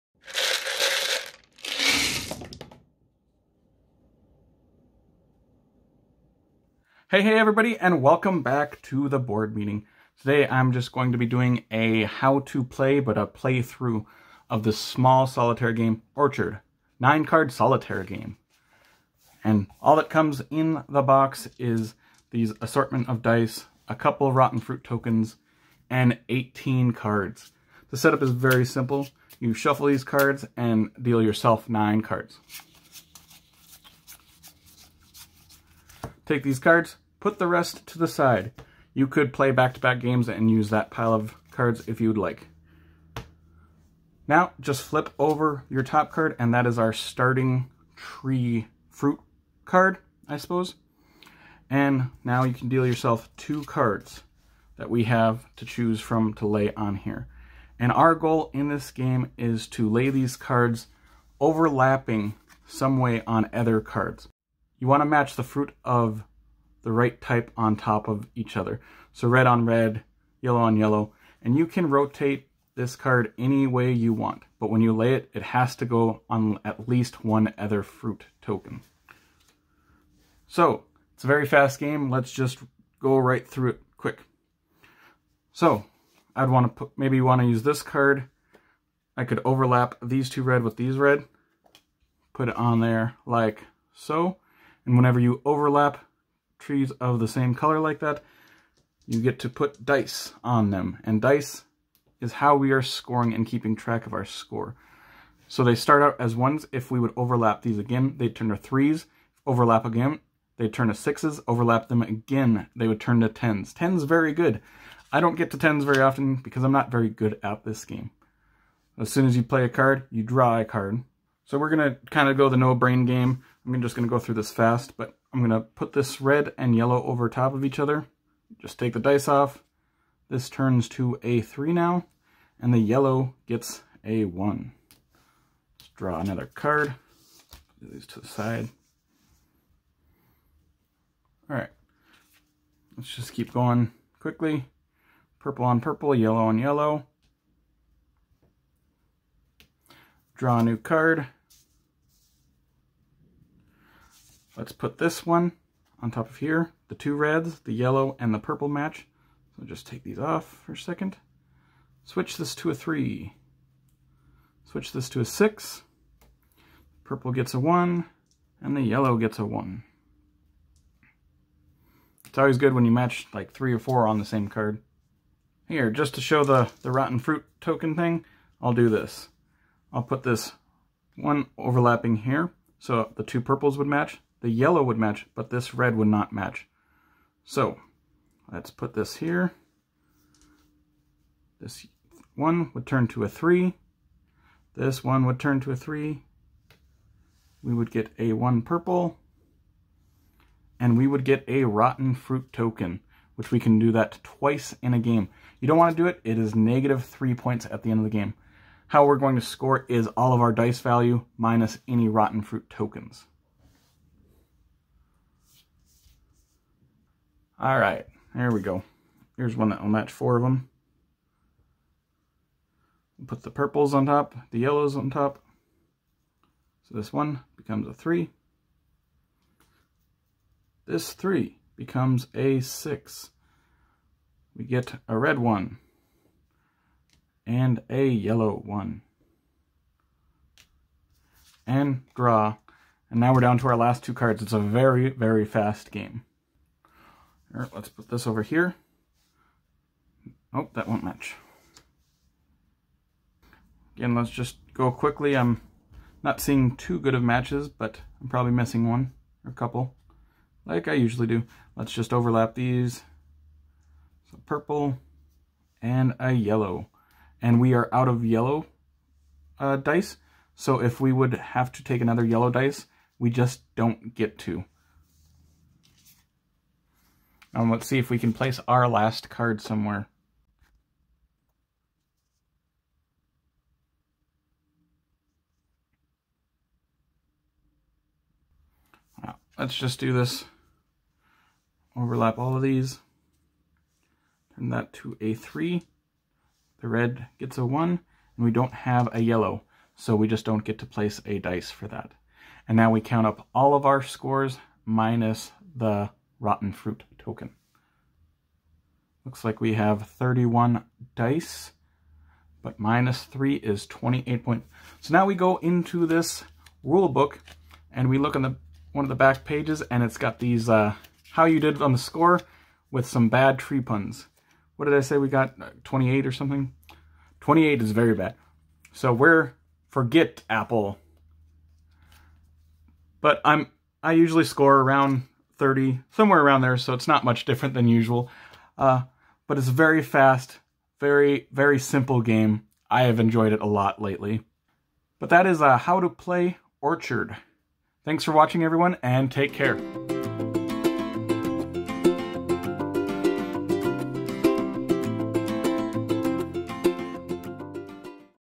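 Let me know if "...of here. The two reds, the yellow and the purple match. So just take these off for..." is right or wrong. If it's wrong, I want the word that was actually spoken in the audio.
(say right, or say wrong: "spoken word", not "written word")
right.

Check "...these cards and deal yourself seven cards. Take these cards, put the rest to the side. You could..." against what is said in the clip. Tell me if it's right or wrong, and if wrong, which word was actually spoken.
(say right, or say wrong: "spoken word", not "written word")
wrong: "nine", not "seven".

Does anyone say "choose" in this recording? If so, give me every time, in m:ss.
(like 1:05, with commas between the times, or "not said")
0:55.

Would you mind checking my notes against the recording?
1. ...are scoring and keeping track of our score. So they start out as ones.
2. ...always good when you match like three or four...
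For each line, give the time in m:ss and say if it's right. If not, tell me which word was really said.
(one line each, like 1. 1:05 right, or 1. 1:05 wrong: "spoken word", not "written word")
1. 1:42 right
2. 2:52 right.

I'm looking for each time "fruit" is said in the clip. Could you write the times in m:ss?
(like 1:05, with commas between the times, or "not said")
0:24, 0:48, 1:05, 1:17, 2:57, 3:22, 3:32, 5:06.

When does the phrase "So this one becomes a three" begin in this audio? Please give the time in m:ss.
3:46.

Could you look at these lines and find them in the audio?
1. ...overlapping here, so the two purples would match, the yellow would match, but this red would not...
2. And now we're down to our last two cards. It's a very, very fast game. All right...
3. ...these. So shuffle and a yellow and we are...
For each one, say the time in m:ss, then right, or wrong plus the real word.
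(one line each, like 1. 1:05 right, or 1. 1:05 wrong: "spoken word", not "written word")
1. 3:01 right
2. 4:03 right
3. 4:22 wrong: "purple", not "shuffle".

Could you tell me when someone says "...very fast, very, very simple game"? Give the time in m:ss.
5:39.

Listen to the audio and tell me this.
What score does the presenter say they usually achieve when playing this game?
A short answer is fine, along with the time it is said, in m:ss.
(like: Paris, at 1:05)
around 30, at 5:34.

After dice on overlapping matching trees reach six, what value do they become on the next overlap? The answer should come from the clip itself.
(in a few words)
10.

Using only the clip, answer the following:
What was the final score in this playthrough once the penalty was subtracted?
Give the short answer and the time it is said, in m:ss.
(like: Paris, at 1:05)
28, at 5:13.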